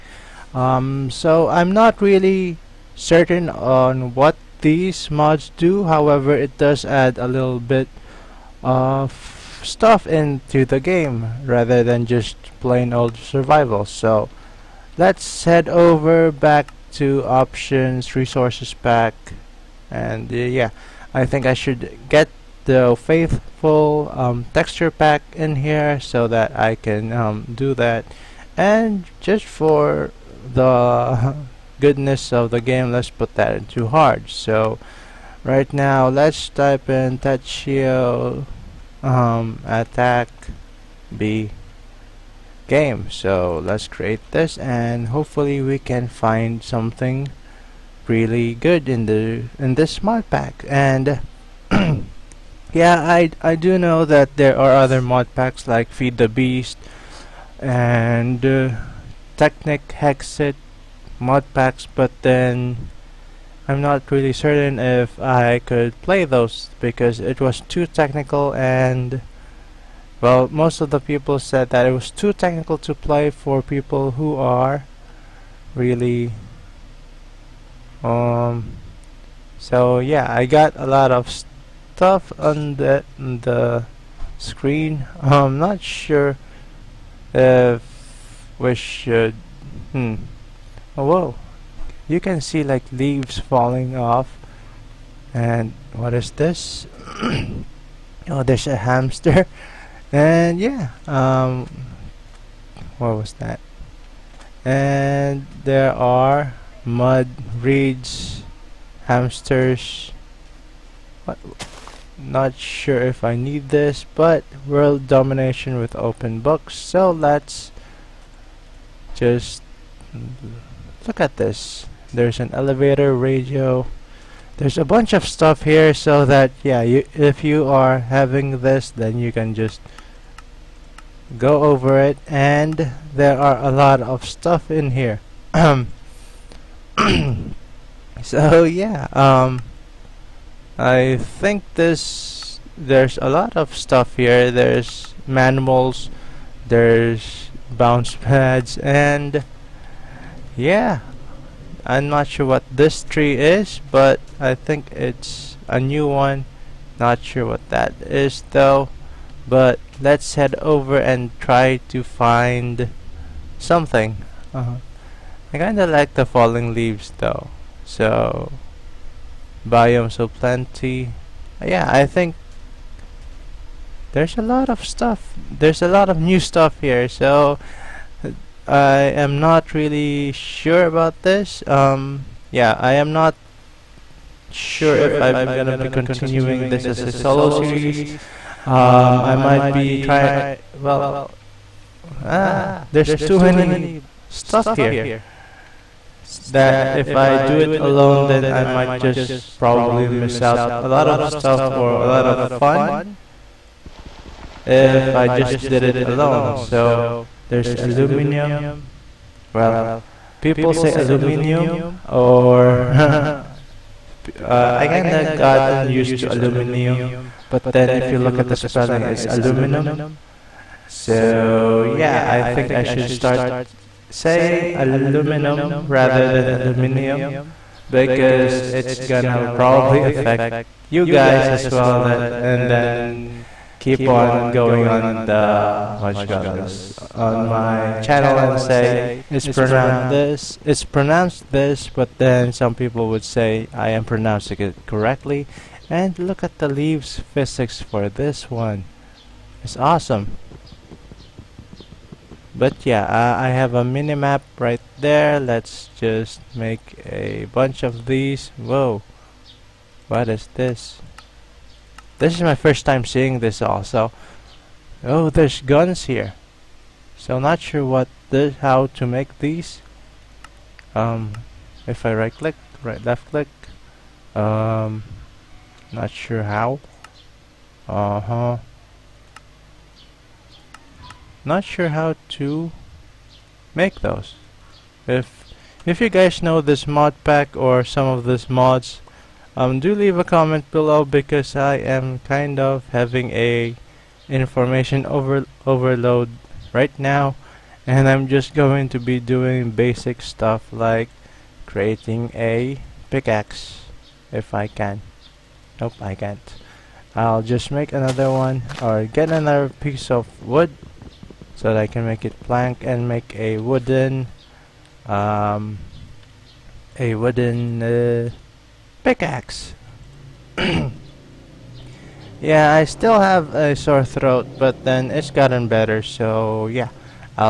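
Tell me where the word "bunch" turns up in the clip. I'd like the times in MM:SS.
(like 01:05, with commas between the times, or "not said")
02:04, 04:17.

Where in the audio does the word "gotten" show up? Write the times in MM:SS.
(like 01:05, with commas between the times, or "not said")
03:35, 05:25.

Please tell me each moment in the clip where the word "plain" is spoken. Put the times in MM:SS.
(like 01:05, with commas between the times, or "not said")
00:12.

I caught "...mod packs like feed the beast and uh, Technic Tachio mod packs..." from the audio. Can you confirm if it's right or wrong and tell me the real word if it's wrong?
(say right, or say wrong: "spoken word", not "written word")
wrong: "Hexit", not "Tachio".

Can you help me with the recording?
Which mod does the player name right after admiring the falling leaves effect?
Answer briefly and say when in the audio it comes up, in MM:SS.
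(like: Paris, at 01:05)
Biomes O' Plenty, at 02:49.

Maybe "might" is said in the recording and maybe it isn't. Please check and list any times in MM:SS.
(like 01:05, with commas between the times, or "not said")
03:09, 03:18.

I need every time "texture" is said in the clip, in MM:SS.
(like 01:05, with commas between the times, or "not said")
00:24.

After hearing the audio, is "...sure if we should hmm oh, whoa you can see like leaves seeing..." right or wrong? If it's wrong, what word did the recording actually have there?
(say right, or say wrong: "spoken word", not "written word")
wrong: "falling", not "seeing".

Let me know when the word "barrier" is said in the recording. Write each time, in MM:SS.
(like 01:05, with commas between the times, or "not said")
not said.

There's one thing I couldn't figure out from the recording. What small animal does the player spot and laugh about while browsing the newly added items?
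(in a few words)
Hamster.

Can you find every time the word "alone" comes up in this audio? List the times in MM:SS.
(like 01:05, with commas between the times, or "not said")
03:17, 03:26.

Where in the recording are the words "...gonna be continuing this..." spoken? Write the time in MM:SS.
03:05.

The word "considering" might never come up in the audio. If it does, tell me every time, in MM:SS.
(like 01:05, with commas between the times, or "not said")
not said.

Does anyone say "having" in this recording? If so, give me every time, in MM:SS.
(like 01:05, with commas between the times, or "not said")
02:07, 04:52.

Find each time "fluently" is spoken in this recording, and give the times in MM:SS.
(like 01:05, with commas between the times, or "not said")
not said.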